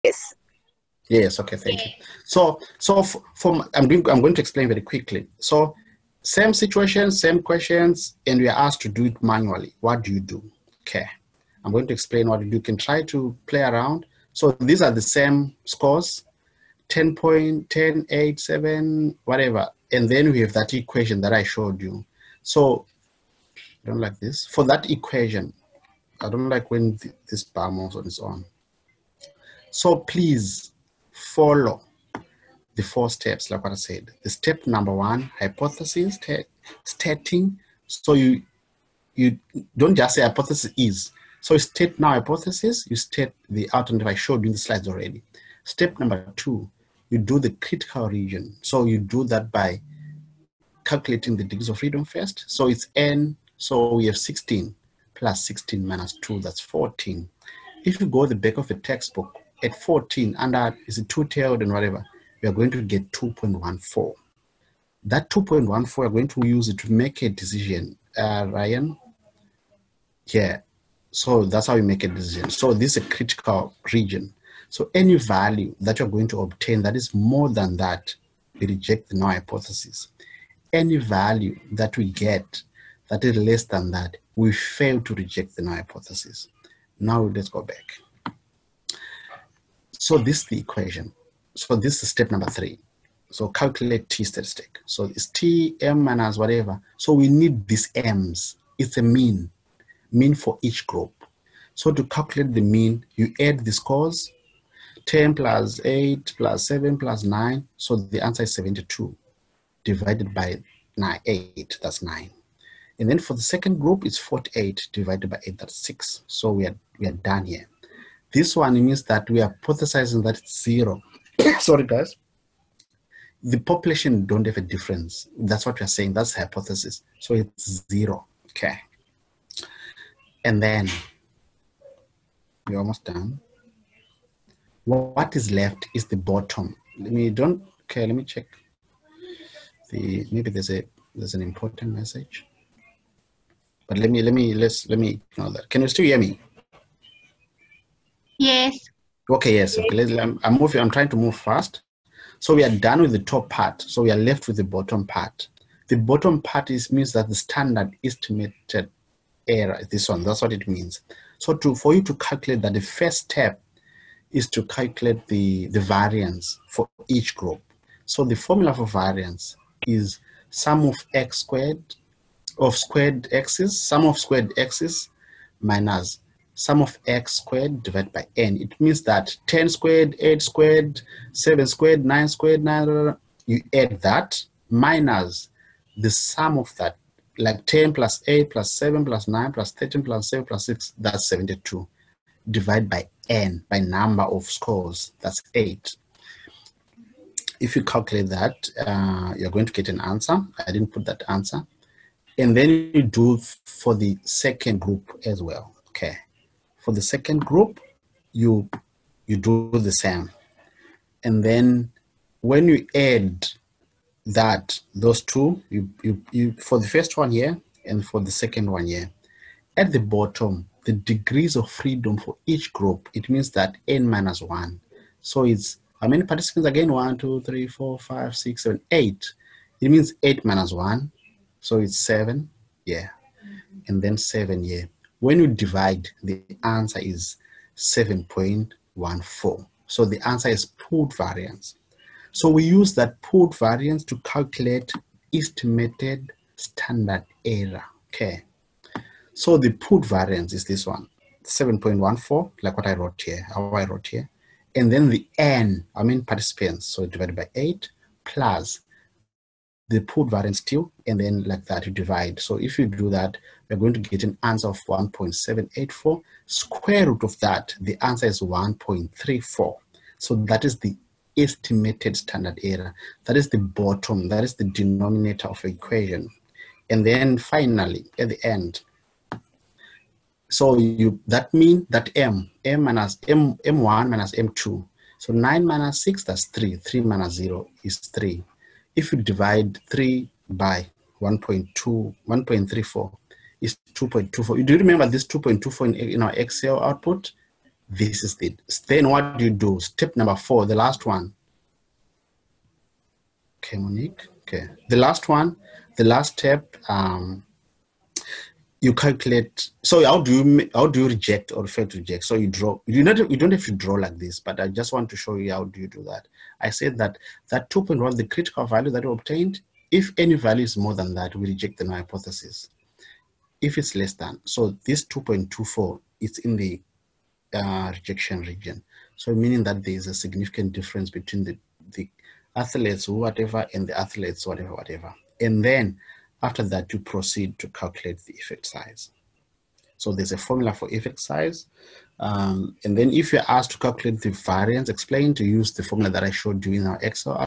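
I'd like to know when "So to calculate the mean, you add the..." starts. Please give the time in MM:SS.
01:41.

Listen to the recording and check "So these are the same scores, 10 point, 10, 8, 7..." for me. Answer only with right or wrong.
right.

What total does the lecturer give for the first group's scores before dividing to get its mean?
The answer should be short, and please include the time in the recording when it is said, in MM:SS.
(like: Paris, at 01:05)
72, at 01:48.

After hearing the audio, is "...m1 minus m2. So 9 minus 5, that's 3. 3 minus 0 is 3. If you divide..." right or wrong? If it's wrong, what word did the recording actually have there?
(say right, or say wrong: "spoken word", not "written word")
wrong: "6", not "5".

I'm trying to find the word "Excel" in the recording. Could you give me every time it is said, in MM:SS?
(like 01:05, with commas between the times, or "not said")
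04:56, 05:47.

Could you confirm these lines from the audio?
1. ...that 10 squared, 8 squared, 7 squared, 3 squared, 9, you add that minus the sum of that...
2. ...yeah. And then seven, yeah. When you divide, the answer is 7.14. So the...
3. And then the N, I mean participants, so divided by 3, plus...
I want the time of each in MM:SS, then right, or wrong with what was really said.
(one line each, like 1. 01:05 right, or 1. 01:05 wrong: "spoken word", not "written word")
1. 02:59 wrong: "9", not "3"
2. 03:52 right
3. 04:14 wrong: "8", not "3".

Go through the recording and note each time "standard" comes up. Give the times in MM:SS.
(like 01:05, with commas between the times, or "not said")
02:37, 04:06, 04:32.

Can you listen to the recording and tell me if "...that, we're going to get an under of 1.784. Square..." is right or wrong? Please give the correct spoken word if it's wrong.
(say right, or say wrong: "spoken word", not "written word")
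wrong: "answer", not "under".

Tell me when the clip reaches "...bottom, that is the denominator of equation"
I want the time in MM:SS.
04:33.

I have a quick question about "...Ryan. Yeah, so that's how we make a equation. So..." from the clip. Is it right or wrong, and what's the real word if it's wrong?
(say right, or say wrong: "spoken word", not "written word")
wrong: "decision", not "equation".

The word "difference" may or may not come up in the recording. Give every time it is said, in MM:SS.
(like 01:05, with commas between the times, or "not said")
02:04, 05:30.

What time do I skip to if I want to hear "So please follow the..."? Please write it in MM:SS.
00:29.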